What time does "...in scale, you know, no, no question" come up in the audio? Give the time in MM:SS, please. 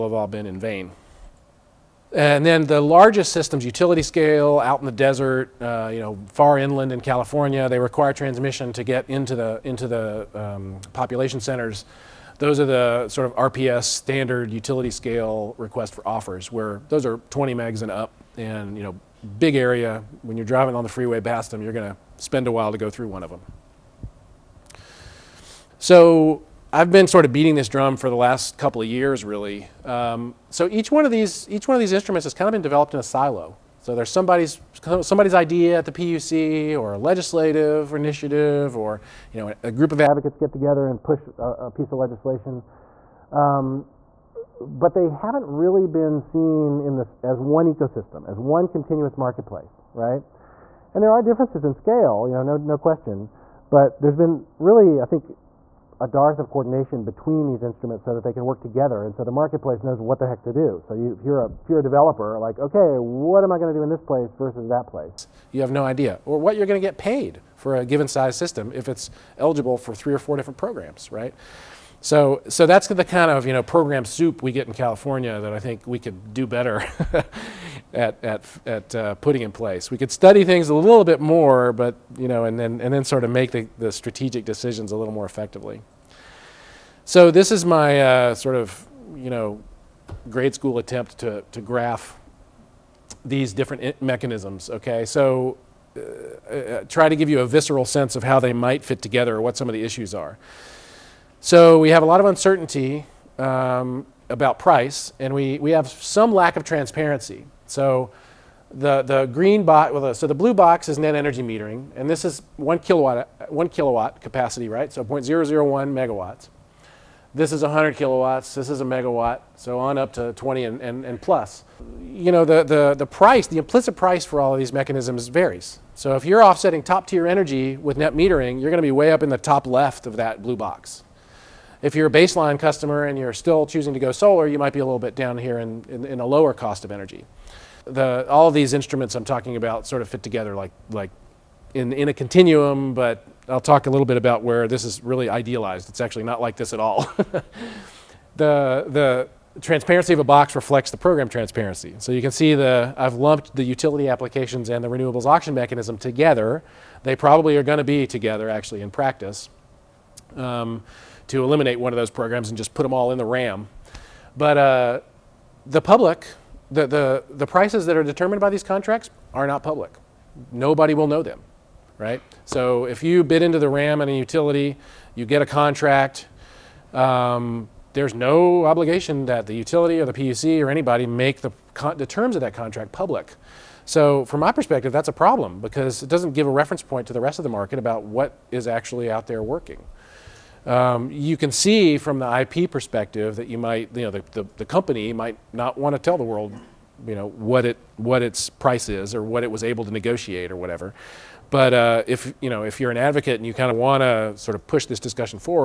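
00:51.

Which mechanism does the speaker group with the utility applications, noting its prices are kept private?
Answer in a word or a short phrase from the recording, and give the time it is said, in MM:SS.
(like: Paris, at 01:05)
Renewables auction mechanism, at 02:34.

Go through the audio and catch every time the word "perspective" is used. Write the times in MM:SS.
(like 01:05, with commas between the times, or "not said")
03:04, 03:12.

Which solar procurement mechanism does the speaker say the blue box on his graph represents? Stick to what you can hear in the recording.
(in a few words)
Net energy metering.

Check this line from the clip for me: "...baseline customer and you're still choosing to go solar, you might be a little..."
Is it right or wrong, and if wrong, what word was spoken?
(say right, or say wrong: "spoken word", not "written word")
right.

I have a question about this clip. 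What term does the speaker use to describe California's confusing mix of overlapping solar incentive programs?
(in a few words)
Program soup.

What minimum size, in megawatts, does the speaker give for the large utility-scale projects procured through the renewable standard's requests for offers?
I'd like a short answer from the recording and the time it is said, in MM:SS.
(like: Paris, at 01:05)
20 megs, at 00:17.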